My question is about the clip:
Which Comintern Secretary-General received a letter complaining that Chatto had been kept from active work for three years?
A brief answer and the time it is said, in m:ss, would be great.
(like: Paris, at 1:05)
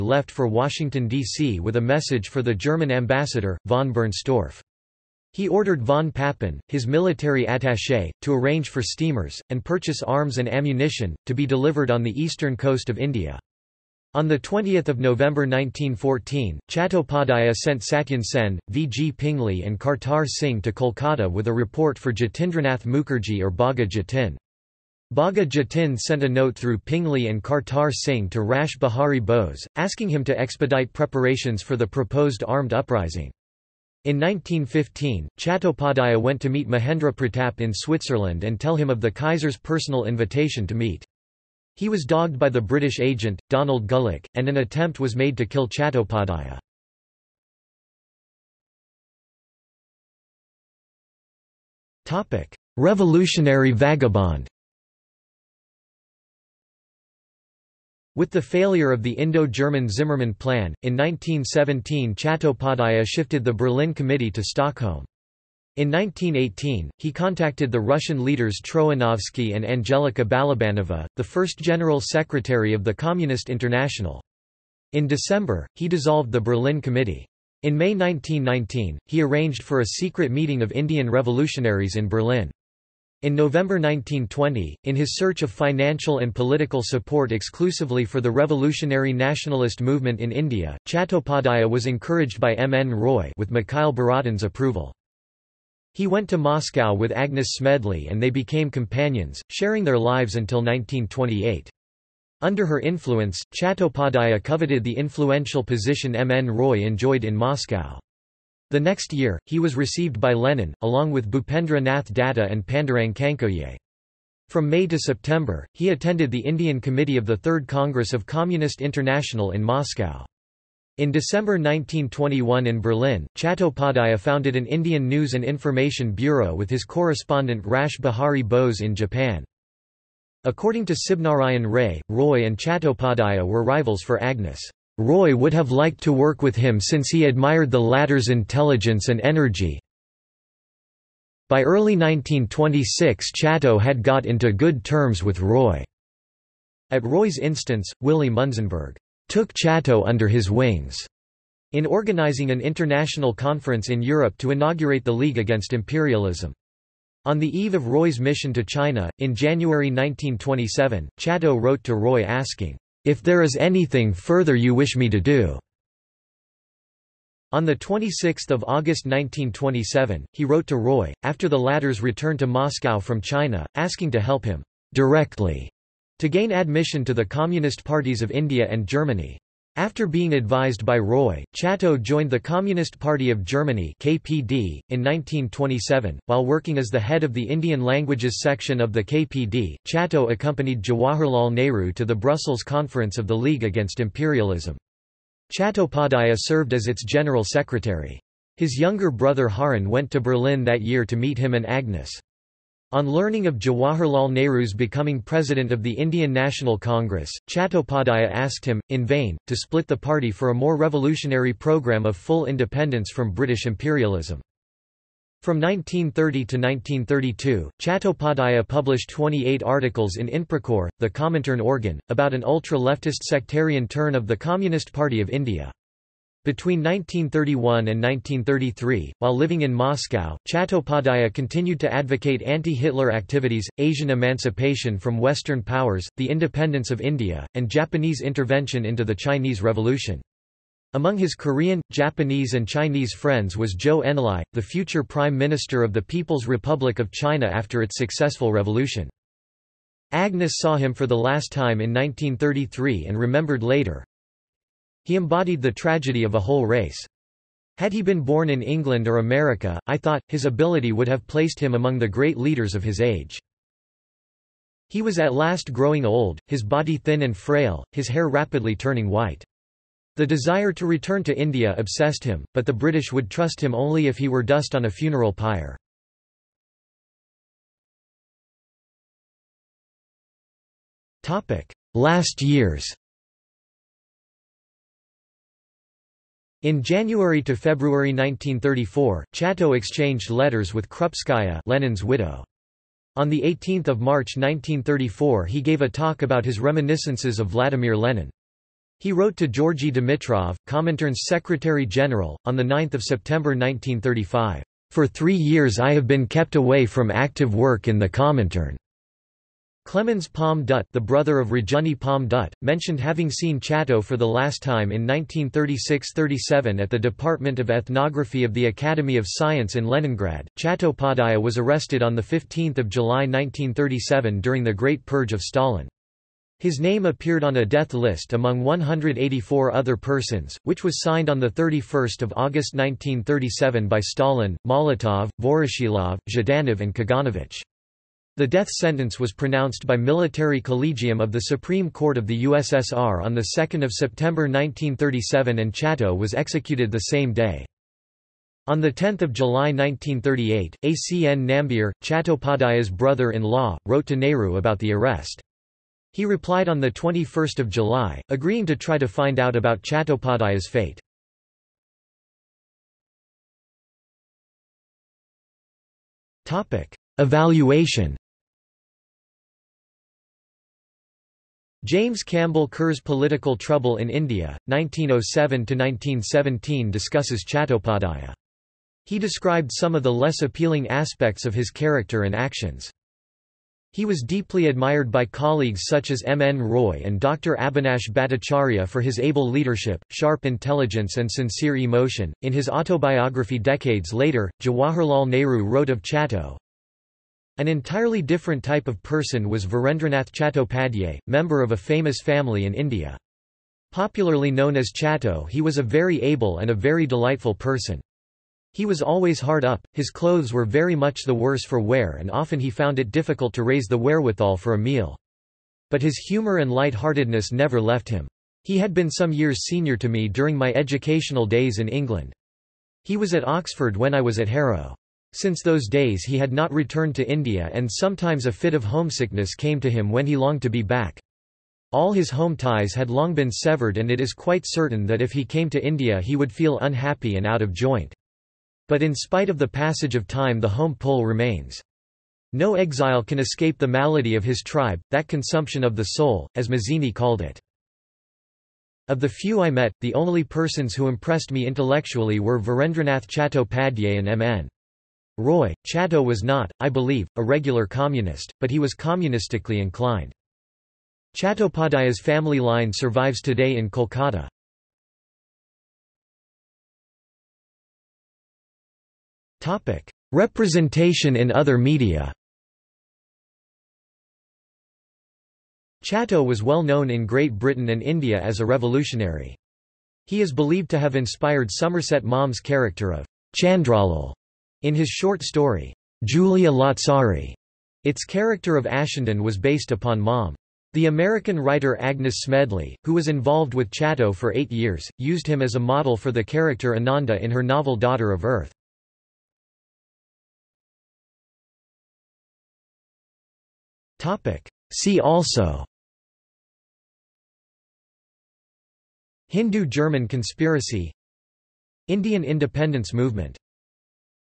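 Georgy Dimitrov, at 4:59.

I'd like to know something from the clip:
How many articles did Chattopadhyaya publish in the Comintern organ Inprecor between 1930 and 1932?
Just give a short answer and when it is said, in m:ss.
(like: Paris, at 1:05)
28, at 3:39.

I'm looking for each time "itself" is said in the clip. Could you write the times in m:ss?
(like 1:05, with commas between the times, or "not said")
not said.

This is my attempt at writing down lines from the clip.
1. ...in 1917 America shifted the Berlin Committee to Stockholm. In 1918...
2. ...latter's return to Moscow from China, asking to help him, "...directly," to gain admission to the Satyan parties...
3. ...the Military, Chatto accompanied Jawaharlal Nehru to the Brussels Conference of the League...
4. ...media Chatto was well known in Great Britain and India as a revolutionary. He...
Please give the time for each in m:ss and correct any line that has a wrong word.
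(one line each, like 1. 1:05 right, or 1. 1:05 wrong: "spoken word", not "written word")
1. 1:00 wrong: "Chattopadhyaya", not "America"
2. 2:51 wrong: "Communist", not "Satyan"
3. 3:08 wrong: "KPD", not "Military"
4. 7:51 right.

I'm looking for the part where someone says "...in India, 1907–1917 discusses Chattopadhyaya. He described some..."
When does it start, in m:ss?
6:13.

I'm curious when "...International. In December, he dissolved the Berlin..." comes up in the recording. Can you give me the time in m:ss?
1:13.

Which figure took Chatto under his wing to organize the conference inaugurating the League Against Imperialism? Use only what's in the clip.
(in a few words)
Willy Munzenberg.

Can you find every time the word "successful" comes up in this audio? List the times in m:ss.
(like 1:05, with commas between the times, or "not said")
4:07.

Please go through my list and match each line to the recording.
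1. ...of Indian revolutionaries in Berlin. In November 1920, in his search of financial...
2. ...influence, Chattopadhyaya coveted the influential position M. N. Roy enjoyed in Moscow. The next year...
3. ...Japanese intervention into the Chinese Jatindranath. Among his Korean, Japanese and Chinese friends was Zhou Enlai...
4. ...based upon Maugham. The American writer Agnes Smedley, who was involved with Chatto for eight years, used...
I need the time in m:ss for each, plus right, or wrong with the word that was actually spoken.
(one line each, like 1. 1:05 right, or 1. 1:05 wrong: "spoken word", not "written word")
1. 1:20 right
2. 1:42 right
3. 3:57 wrong: "Revolution", not "Jatindranath"
4. 8:09 right.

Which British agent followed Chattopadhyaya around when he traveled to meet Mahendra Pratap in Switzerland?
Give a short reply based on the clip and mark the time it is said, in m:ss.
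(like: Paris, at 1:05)
Donald Gullick, at 0:43.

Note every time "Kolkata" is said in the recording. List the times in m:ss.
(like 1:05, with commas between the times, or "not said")
0:20, 7:43.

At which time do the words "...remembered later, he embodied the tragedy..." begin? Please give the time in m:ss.
4:13.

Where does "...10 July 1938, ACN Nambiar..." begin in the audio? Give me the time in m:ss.
5:48.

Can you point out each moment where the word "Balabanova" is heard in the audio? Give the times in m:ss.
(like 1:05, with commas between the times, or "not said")
1:10.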